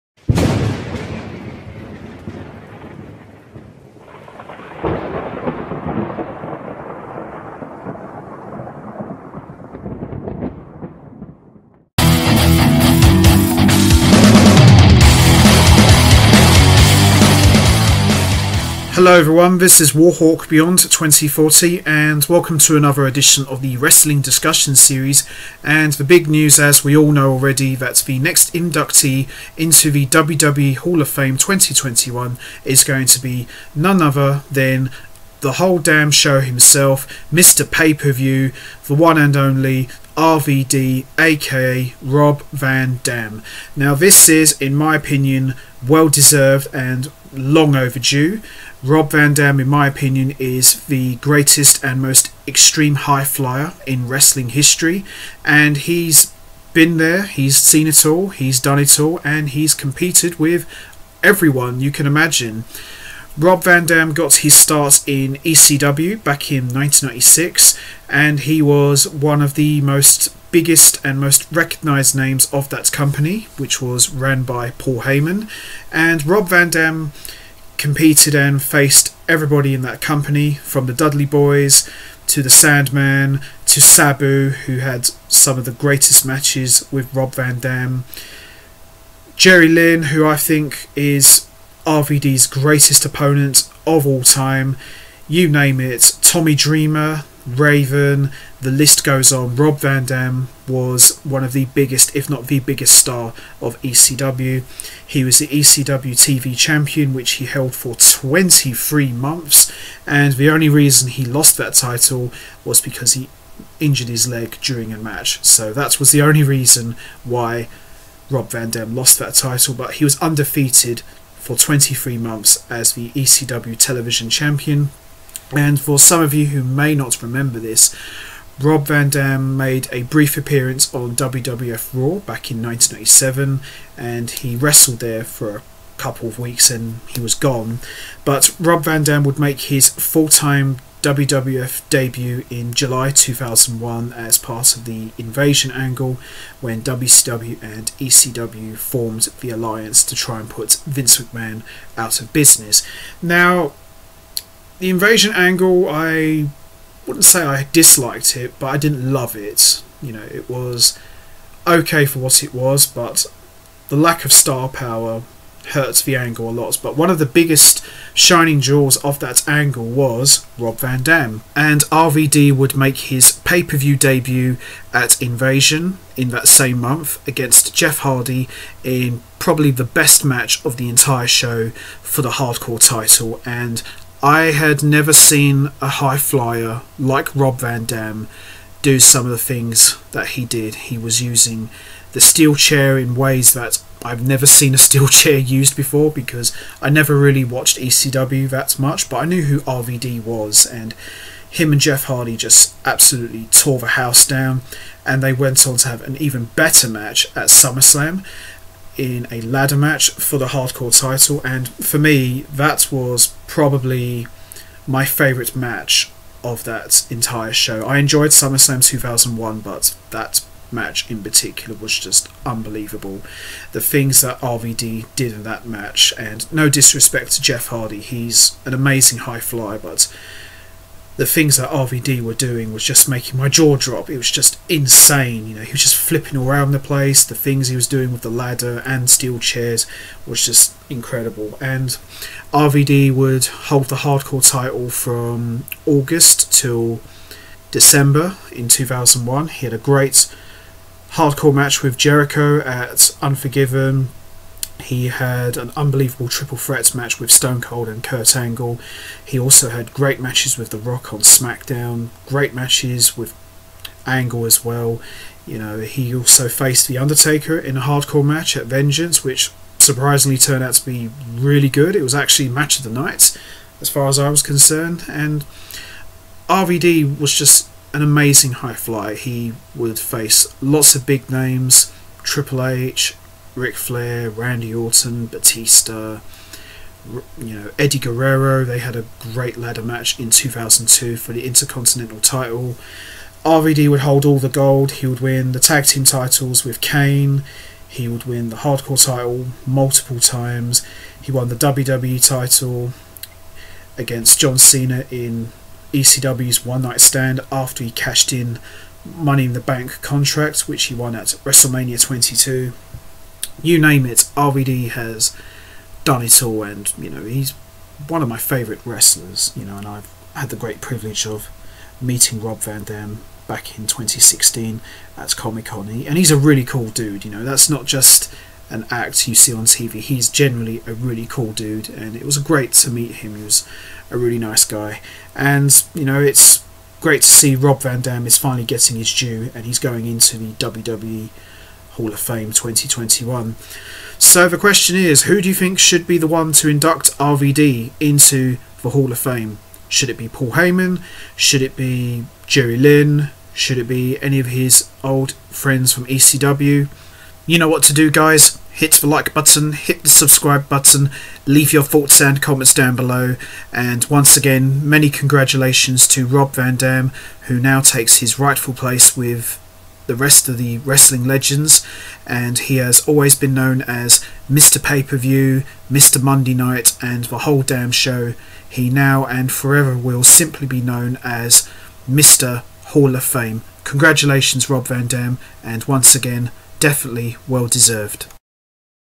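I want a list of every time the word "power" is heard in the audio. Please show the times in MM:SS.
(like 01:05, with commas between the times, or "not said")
02:44.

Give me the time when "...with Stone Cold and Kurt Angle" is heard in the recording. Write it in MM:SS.
04:17.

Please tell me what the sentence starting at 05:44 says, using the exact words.
So the question is, who do you think should be the one to induct RVD into the Hall of Fame?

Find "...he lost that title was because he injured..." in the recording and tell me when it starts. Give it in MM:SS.
01:51.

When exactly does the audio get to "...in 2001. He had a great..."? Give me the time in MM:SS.
04:08.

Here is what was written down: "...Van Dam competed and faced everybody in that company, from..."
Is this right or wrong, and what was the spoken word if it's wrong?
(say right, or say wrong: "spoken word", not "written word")
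right.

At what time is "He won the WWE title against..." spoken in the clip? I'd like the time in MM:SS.
05:01.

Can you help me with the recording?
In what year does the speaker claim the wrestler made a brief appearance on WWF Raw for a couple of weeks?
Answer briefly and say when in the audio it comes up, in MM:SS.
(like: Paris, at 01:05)
1987, at 02:12.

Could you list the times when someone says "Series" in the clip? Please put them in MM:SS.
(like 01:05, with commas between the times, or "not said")
00:24.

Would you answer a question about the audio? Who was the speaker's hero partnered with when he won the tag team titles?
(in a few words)
Kane.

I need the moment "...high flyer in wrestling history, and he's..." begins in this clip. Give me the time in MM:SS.
00:52.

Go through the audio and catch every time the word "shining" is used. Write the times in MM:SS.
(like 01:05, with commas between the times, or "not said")
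02:48.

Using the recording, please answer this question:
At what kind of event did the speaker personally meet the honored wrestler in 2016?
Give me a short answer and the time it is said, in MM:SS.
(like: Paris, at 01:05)
Comic Con, at 05:25.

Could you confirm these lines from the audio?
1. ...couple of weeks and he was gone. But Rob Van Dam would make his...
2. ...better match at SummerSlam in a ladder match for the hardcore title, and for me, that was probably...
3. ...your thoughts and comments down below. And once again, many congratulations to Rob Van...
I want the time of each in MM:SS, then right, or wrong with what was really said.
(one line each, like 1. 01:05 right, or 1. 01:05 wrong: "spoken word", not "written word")
1. 02:15 right
2. 03:26 right
3. 06:01 right.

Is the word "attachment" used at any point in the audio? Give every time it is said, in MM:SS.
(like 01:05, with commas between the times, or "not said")
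not said.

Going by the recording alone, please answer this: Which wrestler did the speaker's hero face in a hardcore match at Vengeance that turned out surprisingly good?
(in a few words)
The Undertaker.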